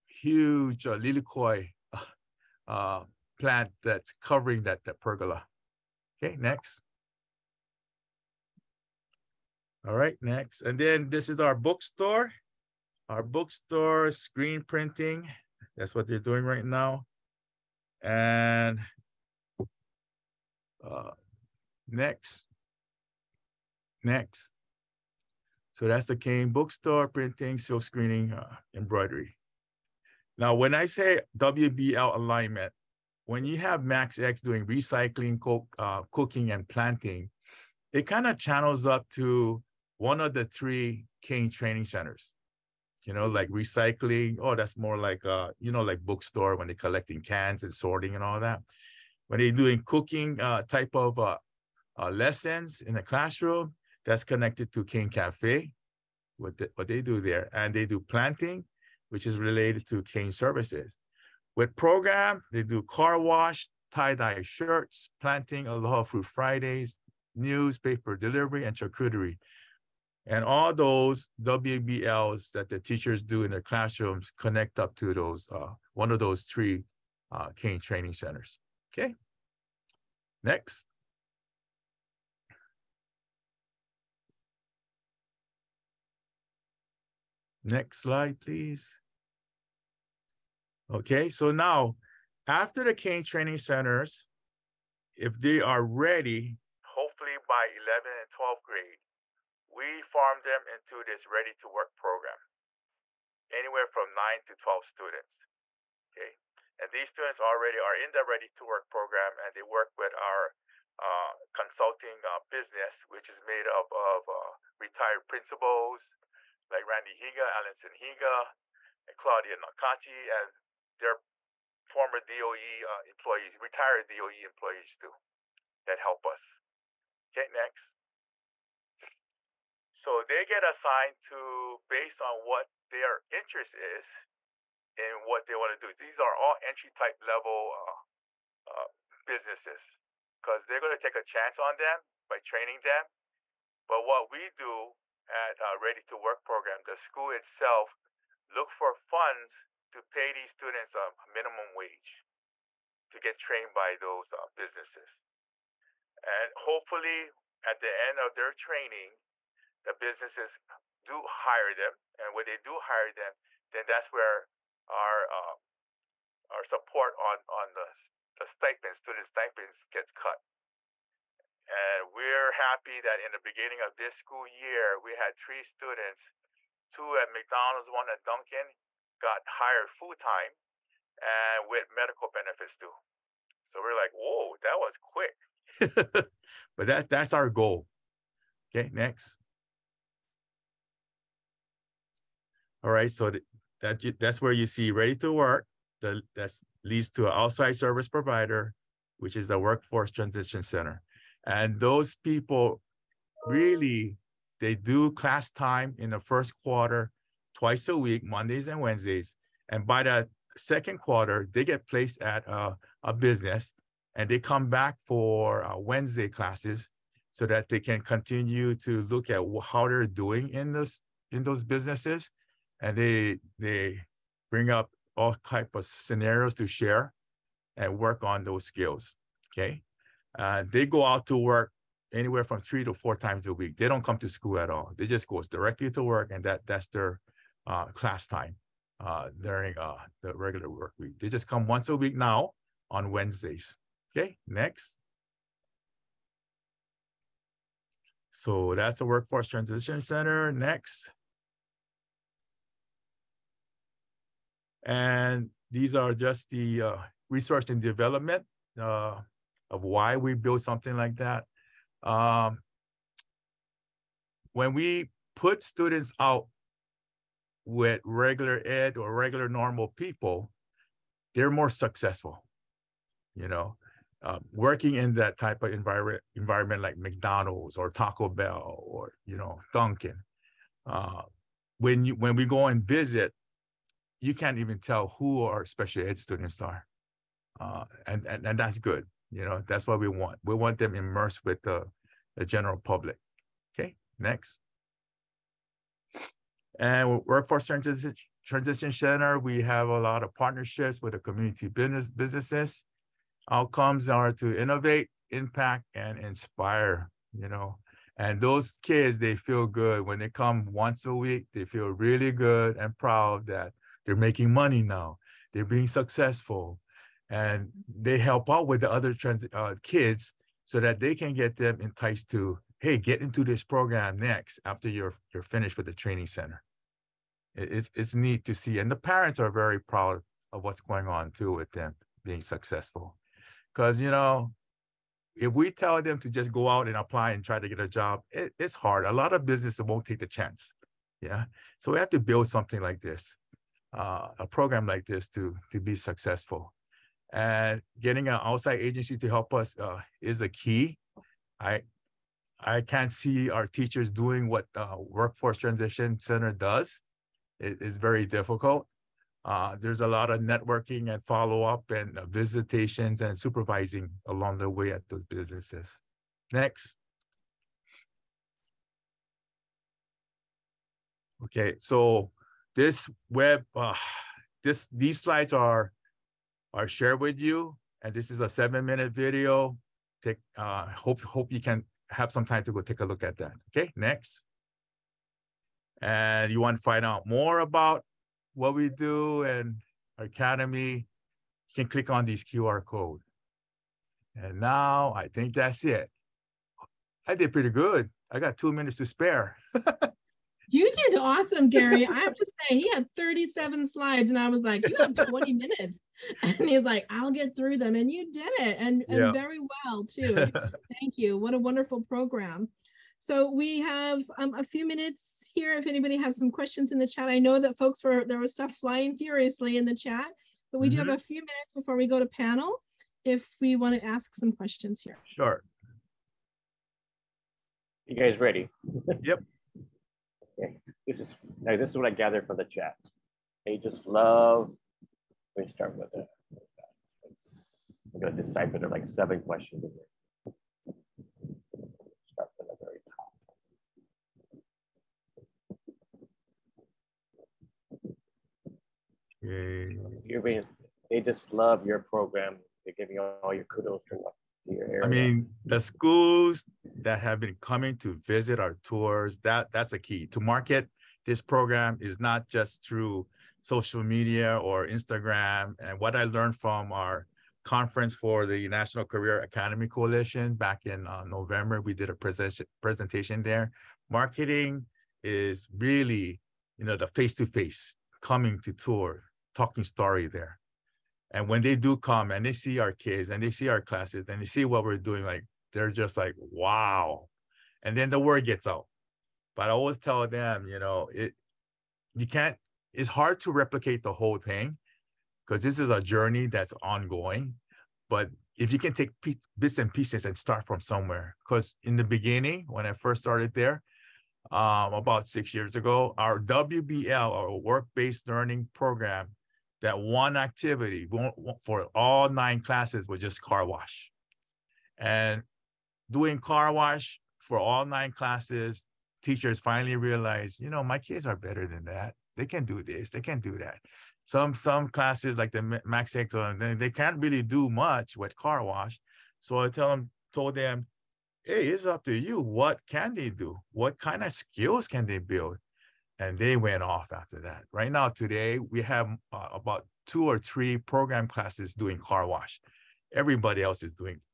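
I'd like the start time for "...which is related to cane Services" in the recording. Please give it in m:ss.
0:59.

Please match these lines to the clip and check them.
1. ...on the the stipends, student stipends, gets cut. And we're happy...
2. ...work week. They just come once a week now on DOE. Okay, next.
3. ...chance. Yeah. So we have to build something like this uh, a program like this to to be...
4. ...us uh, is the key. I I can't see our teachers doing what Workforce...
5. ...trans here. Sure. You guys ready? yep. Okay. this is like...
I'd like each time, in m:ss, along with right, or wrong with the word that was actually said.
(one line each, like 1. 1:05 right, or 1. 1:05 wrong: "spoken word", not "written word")
1. 2:47 right
2. 4:00 wrong: "Wednesdays", not "DOE"
3. 5:40 right
4. 5:49 right
5. 7:04 wrong: "questions", not "trans".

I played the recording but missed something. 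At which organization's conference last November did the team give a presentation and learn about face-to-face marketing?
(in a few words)
National Career Academy Coalition.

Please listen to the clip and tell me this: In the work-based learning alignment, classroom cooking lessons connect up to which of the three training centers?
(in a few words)
Cane Cafe.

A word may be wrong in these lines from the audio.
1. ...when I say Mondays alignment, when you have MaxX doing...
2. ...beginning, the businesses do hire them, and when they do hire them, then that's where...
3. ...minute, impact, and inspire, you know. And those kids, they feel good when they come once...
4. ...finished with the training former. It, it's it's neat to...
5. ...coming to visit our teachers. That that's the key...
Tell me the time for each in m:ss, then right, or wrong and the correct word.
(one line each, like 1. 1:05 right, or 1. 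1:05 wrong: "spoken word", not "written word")
1. 0:30 wrong: "WBL", not "Mondays"
2. 2:38 wrong: "training", not "beginning"
3. 5:04 wrong: "innovate", not "minute"
4. 5:25 wrong: "center", not "former"
5. 7:37 wrong: "tours", not "teachers".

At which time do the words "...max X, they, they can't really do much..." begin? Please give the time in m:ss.
8:45.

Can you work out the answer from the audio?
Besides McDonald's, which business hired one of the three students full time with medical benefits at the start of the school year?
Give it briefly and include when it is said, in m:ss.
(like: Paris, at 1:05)
Dunkin, at 2:58.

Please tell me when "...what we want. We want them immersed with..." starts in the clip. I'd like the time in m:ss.
4:49.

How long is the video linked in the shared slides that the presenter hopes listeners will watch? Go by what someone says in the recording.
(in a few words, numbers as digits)
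7 minutes.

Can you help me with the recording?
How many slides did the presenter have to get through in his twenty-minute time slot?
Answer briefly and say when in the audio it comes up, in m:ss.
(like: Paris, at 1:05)
37, at 6:43.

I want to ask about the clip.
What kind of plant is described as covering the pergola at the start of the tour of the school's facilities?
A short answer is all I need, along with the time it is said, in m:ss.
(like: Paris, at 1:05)
lilikoi, at 0:00.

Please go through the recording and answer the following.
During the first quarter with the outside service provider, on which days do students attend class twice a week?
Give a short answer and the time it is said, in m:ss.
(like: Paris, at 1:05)
Mondays and Wednesdays, at 3:28.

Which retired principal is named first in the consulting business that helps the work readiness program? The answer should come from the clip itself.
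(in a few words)
Randy Higa.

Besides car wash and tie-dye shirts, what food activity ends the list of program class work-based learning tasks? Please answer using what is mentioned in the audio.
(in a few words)
charcuterie.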